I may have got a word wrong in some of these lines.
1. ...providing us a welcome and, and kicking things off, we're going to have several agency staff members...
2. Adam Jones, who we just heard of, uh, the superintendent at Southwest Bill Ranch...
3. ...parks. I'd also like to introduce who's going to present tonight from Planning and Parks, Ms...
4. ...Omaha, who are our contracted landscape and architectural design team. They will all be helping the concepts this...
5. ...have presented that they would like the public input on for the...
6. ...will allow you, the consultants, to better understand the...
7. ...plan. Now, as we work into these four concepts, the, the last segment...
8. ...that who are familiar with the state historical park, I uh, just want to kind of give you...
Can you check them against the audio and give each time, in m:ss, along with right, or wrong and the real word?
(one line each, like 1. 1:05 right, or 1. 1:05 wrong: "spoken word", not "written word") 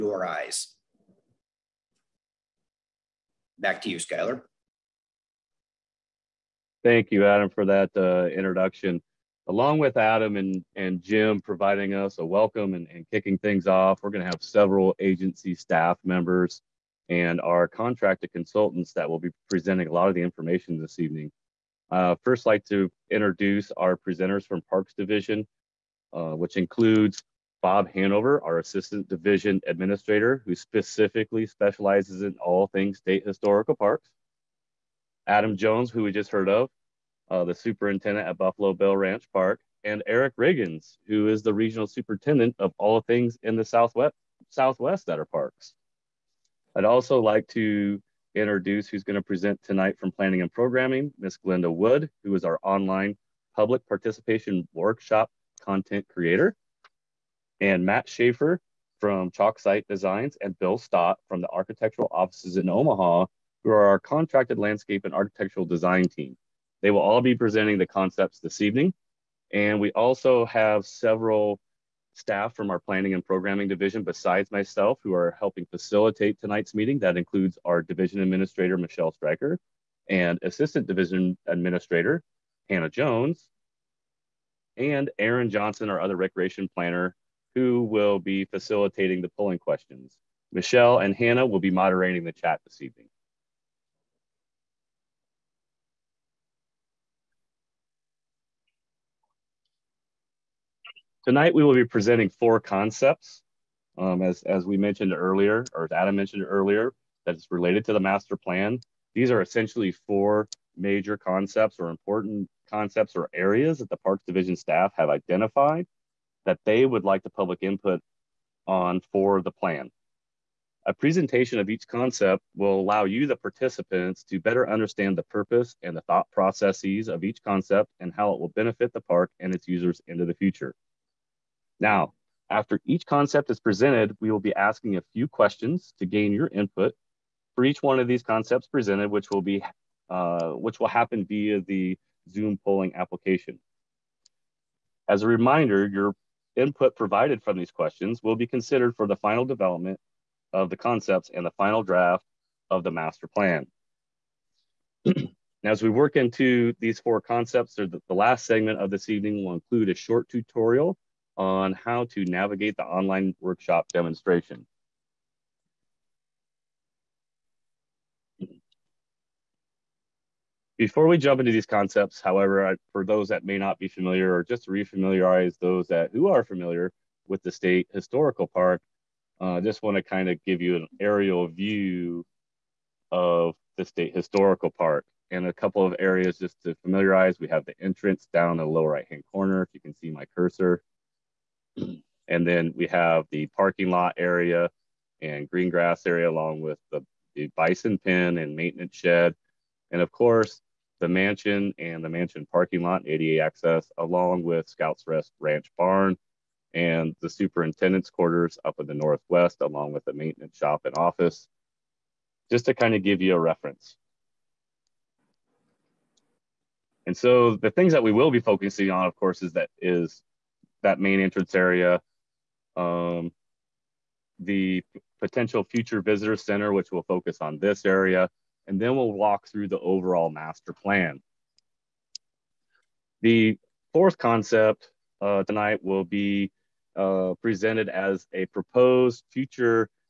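1. 0:11 right
2. 0:35 wrong: "Buffalo", not "Southwest"
3. 0:45 wrong: "Programming", not "Parks"
4. 1:02 wrong: "presenting", not "helping"
5. 1:54 wrong: "identified", not "presented"
6. 2:02 wrong: "participants", not "consultants"
7. 2:33 right
8. 2:55 right.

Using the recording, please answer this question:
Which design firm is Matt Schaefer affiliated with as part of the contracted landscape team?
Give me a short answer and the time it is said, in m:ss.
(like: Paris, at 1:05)
Chalk Site Designs, at 0:59.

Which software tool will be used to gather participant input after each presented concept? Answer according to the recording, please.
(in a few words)
Zoom polling application.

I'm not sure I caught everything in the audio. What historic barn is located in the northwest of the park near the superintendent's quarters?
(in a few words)
Scouts Rest Ranch Barn.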